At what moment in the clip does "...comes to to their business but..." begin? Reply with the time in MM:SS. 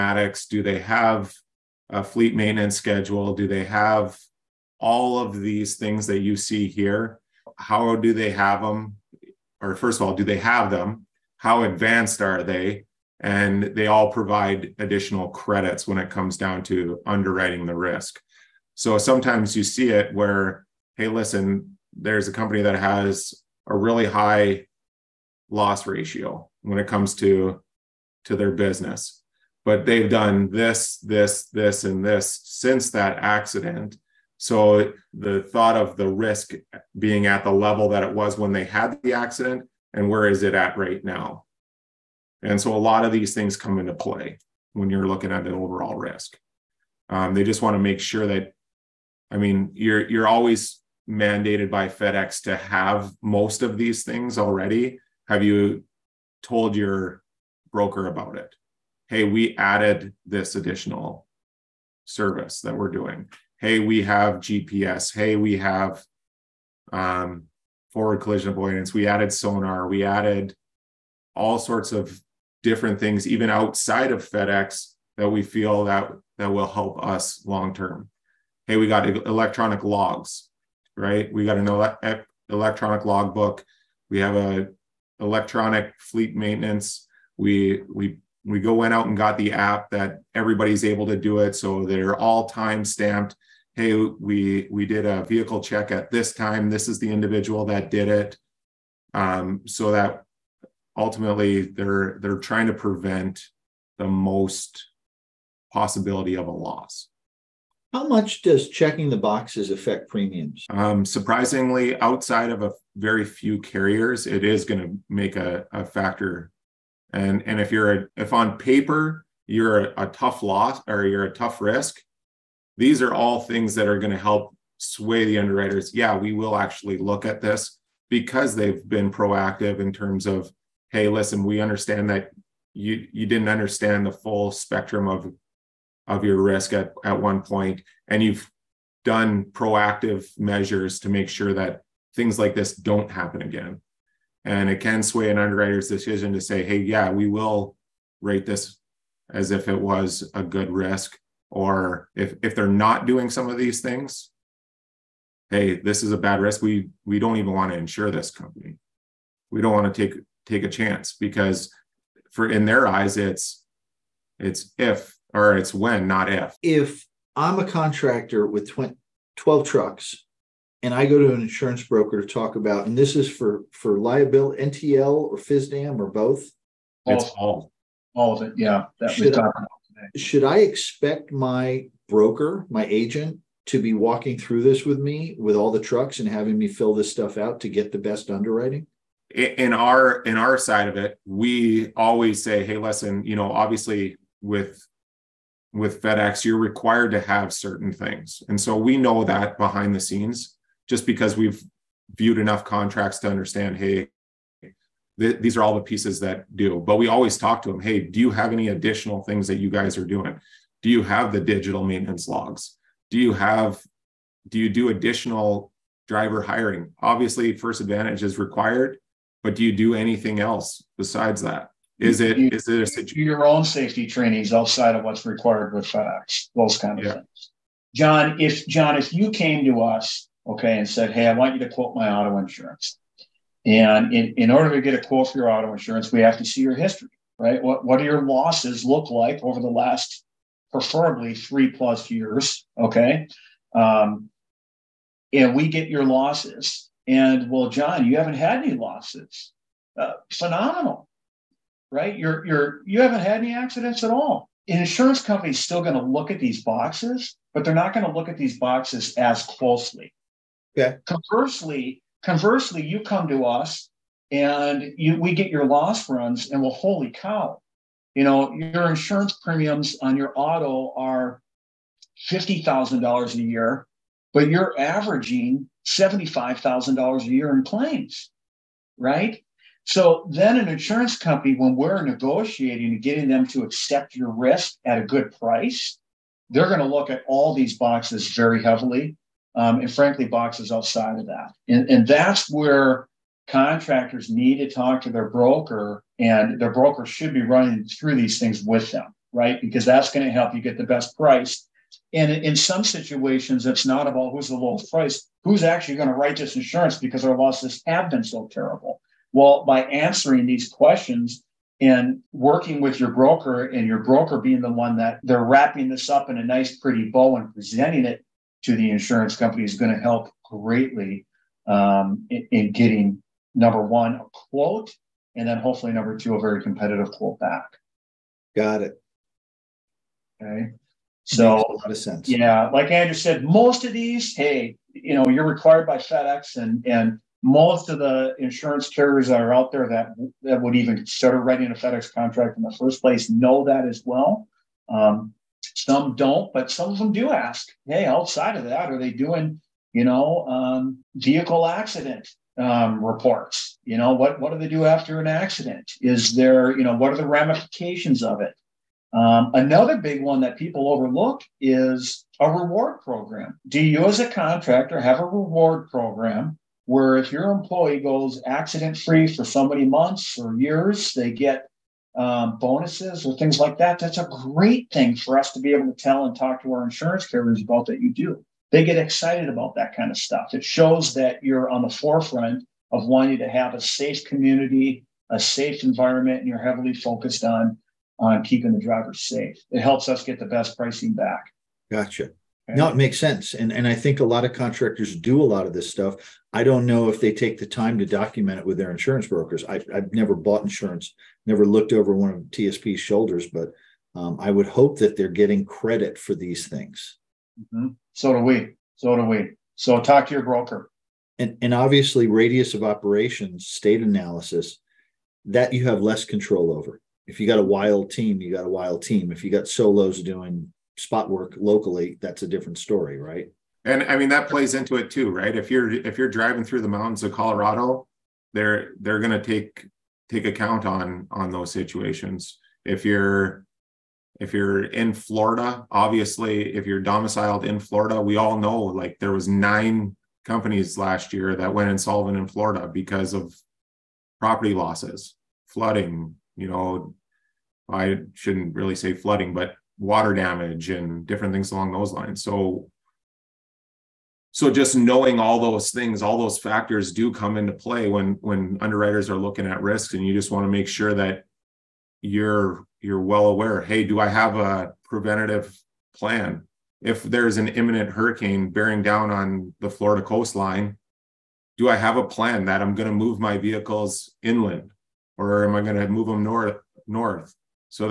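00:26.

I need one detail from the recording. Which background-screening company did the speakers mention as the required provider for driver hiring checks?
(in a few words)
First Advantage.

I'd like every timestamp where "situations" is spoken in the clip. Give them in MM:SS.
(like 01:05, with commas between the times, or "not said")
05:02, 07:11.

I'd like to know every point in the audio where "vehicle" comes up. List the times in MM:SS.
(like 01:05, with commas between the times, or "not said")
01:35, 05:51, 07:53.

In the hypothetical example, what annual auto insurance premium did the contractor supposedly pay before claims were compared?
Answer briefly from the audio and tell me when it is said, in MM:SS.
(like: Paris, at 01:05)
$50,000, at 04:32.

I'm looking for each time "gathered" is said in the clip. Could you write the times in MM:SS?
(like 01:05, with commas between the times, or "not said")
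not said.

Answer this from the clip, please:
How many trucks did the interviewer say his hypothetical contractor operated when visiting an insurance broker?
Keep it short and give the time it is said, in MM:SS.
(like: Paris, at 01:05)
12, at 02:49.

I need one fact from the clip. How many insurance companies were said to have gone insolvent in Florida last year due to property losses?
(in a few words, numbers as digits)
9.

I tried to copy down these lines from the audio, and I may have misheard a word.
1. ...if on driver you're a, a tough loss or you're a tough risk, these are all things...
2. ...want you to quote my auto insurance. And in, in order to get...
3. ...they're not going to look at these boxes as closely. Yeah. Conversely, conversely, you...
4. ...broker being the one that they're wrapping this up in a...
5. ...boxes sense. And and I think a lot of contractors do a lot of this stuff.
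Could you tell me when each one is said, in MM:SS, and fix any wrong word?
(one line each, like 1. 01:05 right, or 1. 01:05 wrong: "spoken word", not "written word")
1. 01:58 wrong: "paper", not "driver"
2. 03:51 right
3. 04:17 right
4. 05:14 right
5. 06:32 wrong: "makes", not "boxes".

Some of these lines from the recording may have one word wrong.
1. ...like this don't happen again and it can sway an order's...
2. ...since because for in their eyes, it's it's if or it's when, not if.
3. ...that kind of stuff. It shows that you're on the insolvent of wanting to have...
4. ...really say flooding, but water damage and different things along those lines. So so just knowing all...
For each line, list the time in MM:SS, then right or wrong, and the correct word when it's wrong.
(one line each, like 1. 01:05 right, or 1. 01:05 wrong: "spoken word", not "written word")
1. 02:22 wrong: "underwriter", not "order"
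2. 02:40 wrong: "chance", not "since"
3. 06:19 wrong: "forefront", not "insolvent"
4. 07:28 right.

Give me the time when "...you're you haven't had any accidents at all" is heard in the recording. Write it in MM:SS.
04:12.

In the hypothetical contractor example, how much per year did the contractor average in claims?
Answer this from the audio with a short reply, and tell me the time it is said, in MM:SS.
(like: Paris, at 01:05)
$75,000, at 04:35.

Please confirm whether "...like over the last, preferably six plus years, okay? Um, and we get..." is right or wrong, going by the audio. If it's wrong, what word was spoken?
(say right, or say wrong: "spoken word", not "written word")
wrong: "three", not "six".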